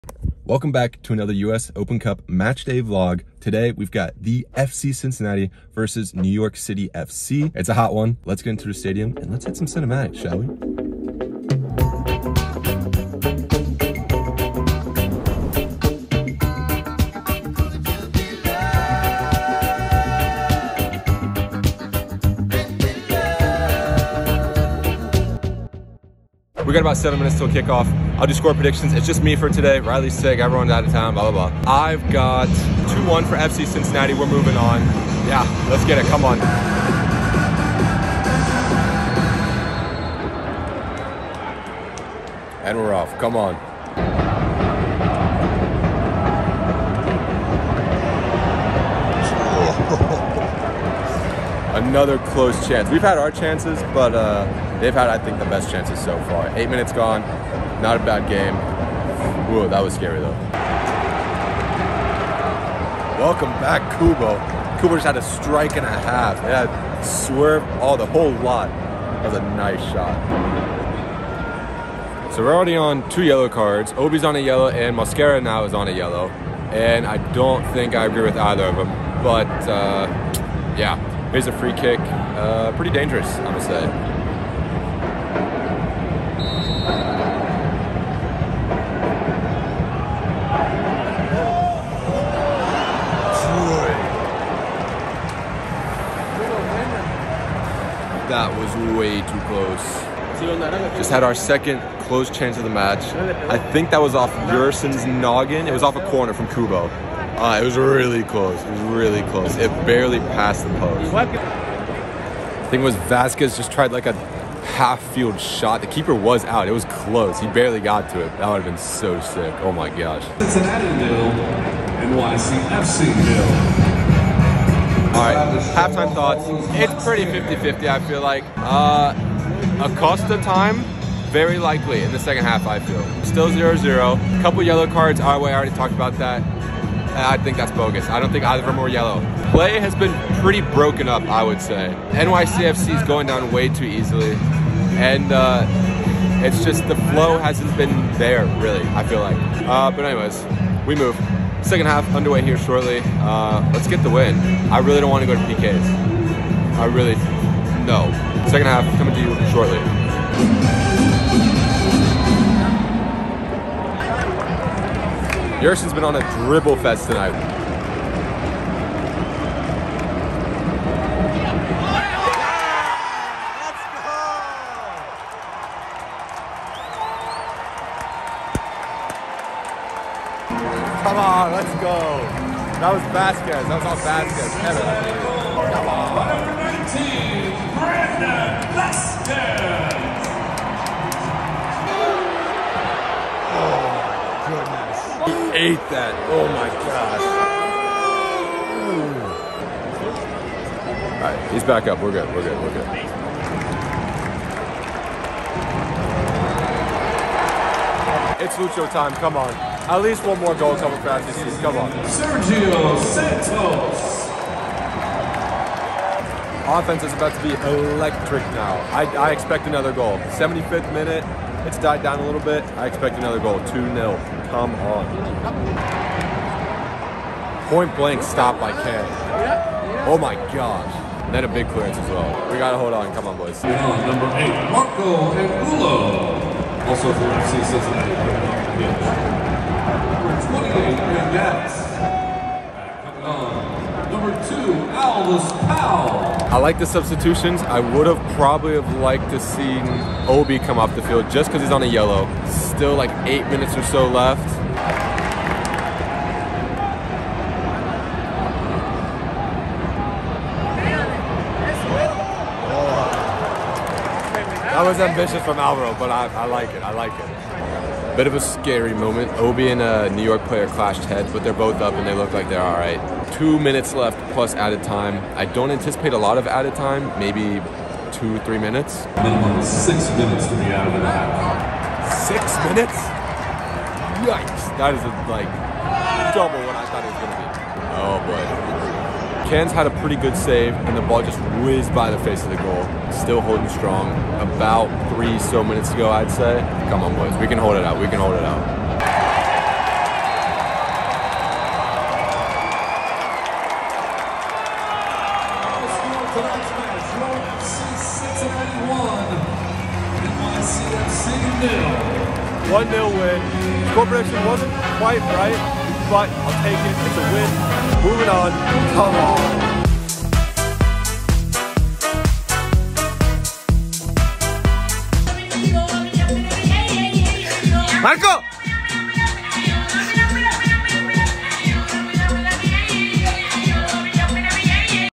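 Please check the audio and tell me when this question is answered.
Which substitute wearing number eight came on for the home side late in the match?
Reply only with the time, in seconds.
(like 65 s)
234 s.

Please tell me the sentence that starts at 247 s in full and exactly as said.
I would have probably have liked to see Obi come off the field just because he's on a yellow.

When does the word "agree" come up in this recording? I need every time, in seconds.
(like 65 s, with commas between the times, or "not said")
78 s.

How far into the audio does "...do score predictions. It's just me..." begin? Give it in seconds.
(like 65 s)
28 s.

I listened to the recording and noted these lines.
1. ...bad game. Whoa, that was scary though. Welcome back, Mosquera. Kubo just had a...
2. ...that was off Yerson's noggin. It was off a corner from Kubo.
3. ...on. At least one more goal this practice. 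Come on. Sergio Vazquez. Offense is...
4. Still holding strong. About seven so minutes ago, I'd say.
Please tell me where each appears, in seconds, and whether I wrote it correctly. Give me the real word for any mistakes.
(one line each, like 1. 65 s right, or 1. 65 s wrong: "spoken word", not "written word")
1. 58 s wrong: "Kubo", not "Mosquera"
2. 103 s right
3. 209 s wrong: "Santos", not "Vazquez"
4. 293 s wrong: "three", not "seven".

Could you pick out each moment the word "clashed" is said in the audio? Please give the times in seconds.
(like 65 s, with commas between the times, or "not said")
270 s.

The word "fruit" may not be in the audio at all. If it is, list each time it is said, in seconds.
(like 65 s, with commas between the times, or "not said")
not said.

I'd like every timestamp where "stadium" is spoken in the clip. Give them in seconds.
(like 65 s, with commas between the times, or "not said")
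8 s.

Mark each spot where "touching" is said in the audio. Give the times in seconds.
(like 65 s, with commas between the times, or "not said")
not said.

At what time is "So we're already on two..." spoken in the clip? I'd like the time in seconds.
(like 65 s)
72 s.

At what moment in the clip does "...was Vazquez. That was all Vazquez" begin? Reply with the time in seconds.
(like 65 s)
182 s.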